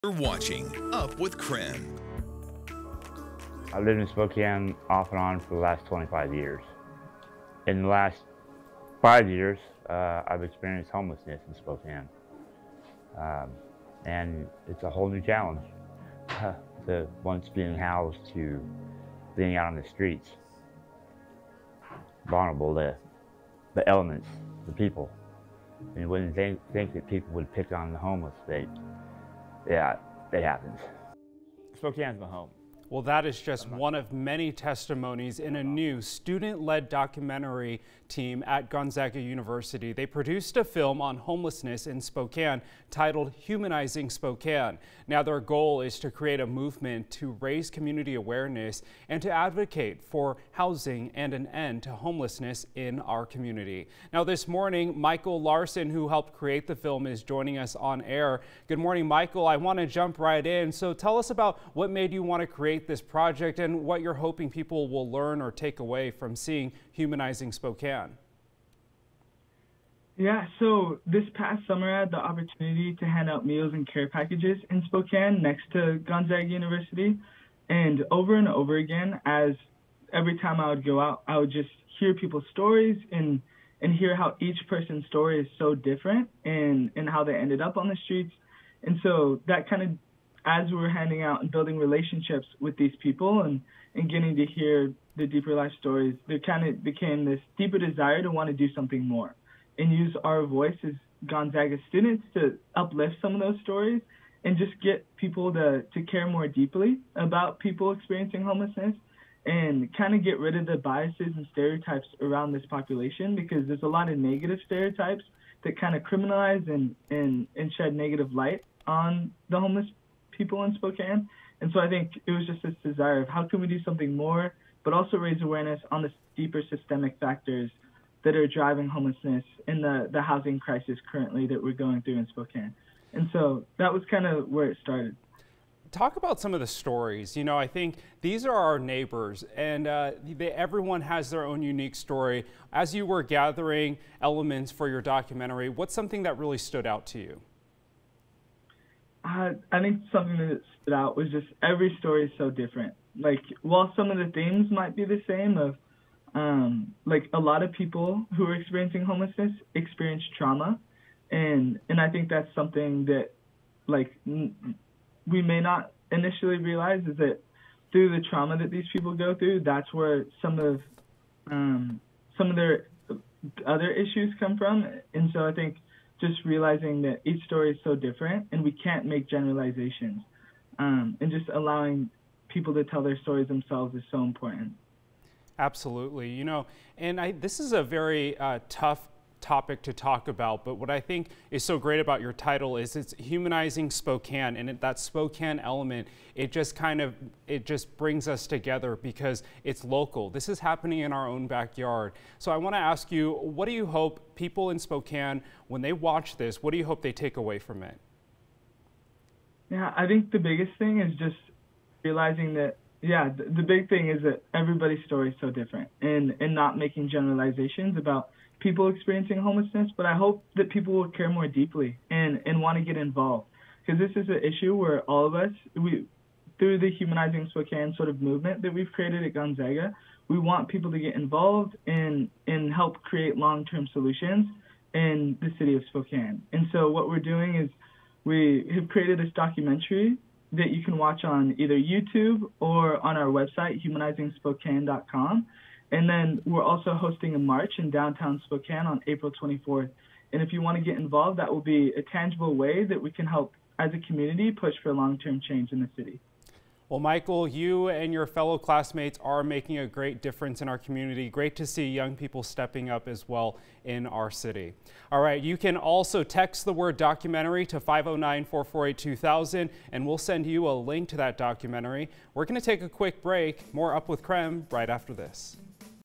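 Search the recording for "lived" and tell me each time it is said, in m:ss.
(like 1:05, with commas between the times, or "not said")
0:03.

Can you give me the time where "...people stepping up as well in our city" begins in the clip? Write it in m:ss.
4:22.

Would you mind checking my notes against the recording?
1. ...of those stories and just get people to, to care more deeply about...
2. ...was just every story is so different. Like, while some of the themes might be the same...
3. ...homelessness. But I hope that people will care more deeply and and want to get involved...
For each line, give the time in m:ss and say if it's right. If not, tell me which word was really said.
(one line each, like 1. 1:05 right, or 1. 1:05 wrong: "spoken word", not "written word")
1. 1:43 right
2. 2:31 right
3. 3:39 right.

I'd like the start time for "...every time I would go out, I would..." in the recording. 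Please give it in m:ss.
1:20.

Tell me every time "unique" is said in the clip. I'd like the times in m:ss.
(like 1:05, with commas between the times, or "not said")
2:21.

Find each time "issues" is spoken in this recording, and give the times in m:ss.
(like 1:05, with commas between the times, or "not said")
2:53, 3:44.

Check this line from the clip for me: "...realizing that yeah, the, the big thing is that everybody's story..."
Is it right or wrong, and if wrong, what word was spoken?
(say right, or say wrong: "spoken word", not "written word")
right.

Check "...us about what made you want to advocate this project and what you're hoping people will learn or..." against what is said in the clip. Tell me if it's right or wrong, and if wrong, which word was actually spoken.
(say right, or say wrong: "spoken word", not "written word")
wrong: "create", not "advocate".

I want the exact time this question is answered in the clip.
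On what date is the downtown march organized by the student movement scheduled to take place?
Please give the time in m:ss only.
4:09.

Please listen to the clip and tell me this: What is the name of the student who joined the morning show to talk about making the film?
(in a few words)
Michael Larson.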